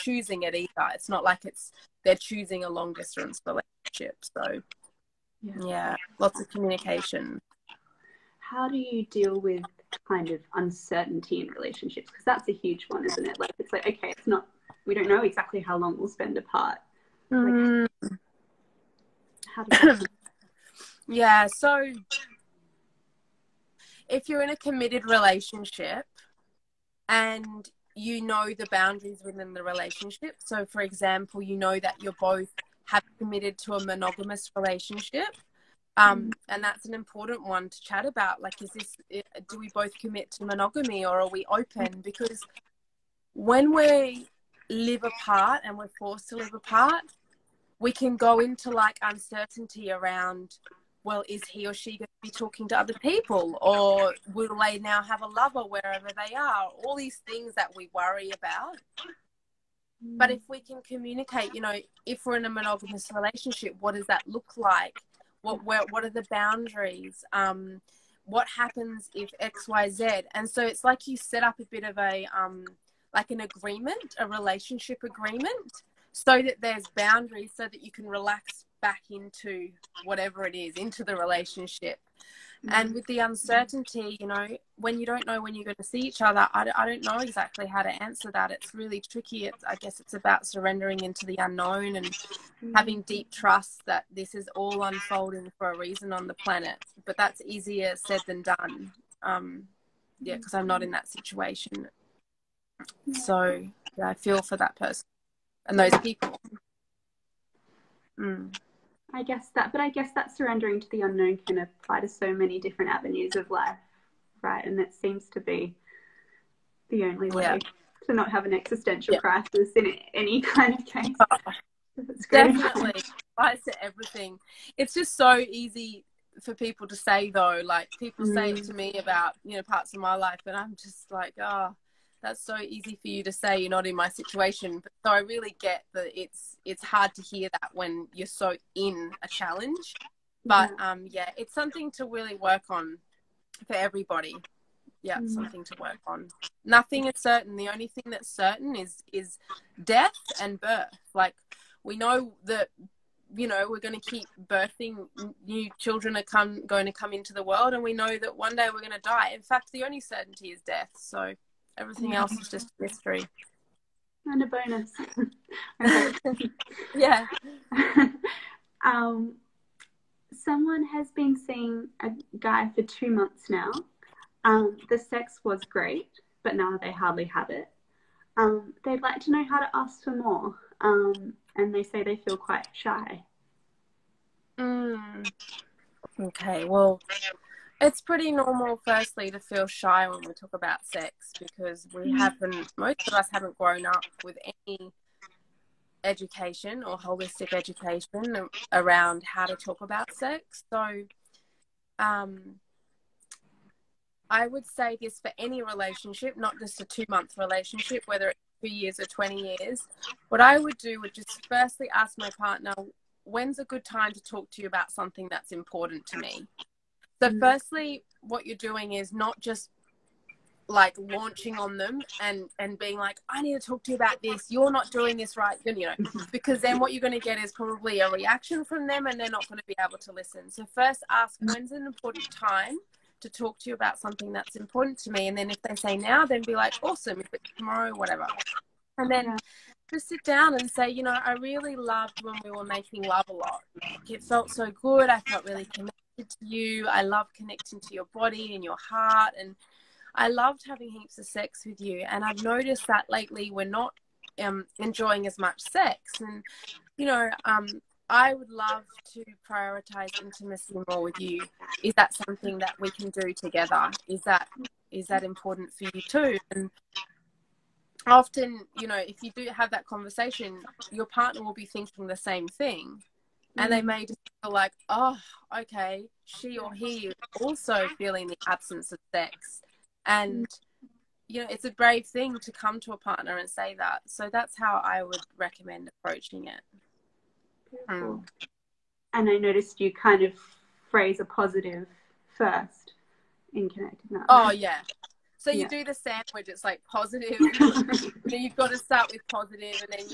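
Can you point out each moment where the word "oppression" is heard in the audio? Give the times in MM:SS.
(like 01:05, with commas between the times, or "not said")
not said.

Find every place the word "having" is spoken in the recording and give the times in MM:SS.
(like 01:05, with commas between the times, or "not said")
01:32, 04:10.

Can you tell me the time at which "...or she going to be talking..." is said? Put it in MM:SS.
00:51.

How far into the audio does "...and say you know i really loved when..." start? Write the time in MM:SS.
04:00.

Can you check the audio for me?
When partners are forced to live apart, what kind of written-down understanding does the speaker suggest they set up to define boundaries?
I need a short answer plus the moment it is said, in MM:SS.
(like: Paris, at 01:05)
relationship agreement, at 01:14.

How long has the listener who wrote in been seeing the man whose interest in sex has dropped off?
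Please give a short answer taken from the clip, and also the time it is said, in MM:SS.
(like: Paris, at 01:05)
2 months, at 02:52.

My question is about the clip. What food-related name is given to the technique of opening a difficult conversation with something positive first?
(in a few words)
the sandwich.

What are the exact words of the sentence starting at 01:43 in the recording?
So yeah, I feel for that person and those people.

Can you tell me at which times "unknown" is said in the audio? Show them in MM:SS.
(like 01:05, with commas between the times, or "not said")
01:31, 01:51.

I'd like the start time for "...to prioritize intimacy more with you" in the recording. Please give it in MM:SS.
04:19.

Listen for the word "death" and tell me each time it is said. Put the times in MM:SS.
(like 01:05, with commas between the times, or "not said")
02:29, 02:40.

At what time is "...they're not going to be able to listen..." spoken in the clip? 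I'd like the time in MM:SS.
03:49.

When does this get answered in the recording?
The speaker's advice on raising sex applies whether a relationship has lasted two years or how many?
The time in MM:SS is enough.
03:29.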